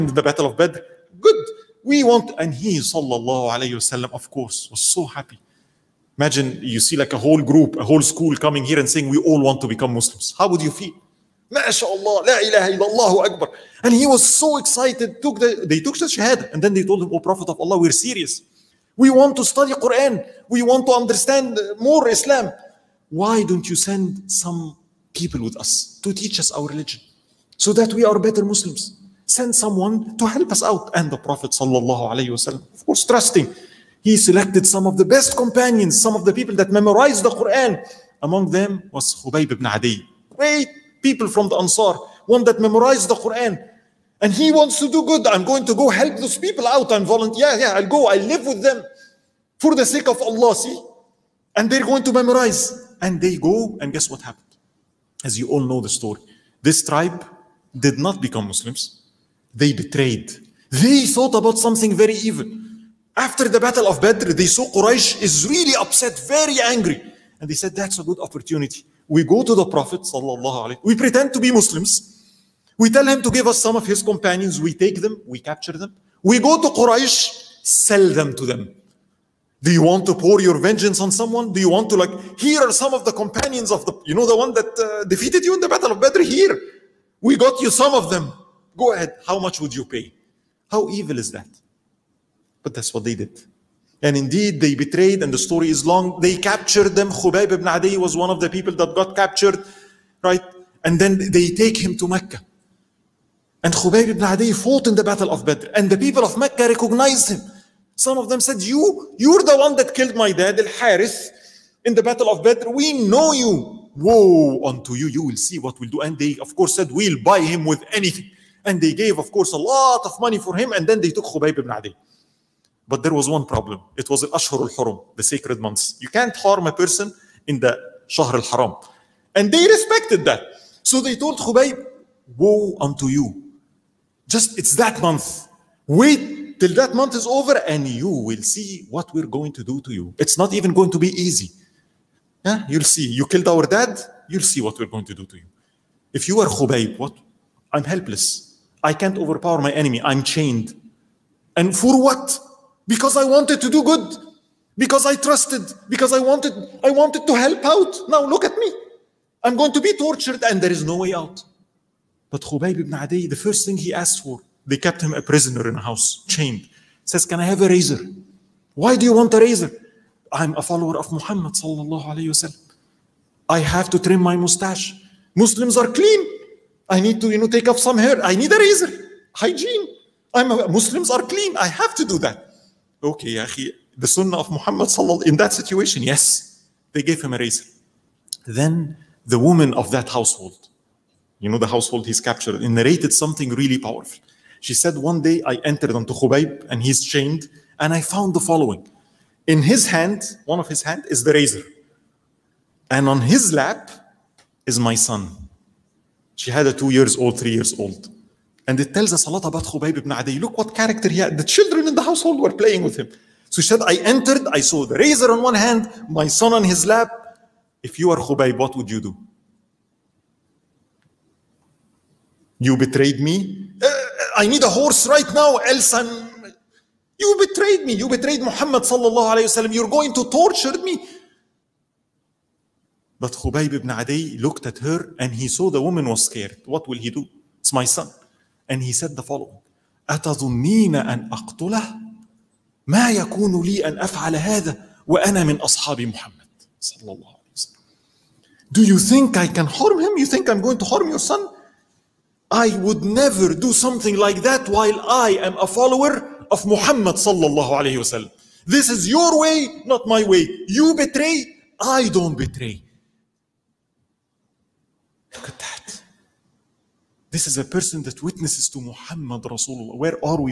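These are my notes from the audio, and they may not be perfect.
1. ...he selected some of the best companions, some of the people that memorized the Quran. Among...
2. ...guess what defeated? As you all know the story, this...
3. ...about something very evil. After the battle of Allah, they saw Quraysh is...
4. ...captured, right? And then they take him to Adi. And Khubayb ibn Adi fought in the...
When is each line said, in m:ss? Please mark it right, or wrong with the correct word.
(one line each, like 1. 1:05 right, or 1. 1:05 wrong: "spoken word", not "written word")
1. 0:34 right
2. 0:53 wrong: "happened", not "defeated"
3. 1:01 wrong: "Badr", not "Allah"
4. 1:39 wrong: "Mecca", not "Adi".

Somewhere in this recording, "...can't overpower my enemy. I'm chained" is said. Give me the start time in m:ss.
2:29.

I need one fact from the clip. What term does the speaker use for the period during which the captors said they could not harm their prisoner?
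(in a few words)
Al-Ashhur al-Hurum.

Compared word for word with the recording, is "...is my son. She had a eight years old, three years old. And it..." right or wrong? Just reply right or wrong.
wrong.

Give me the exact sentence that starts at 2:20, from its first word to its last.
It's not even going to be easy.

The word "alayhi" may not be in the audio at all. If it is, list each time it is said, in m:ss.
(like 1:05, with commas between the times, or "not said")
3:49, 4:17.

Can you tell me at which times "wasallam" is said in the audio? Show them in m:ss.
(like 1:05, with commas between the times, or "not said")
3:49, 4:17.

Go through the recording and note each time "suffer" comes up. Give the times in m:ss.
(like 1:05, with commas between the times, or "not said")
not said.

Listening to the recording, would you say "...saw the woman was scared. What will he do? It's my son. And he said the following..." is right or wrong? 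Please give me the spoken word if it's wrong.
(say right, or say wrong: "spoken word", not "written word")
right.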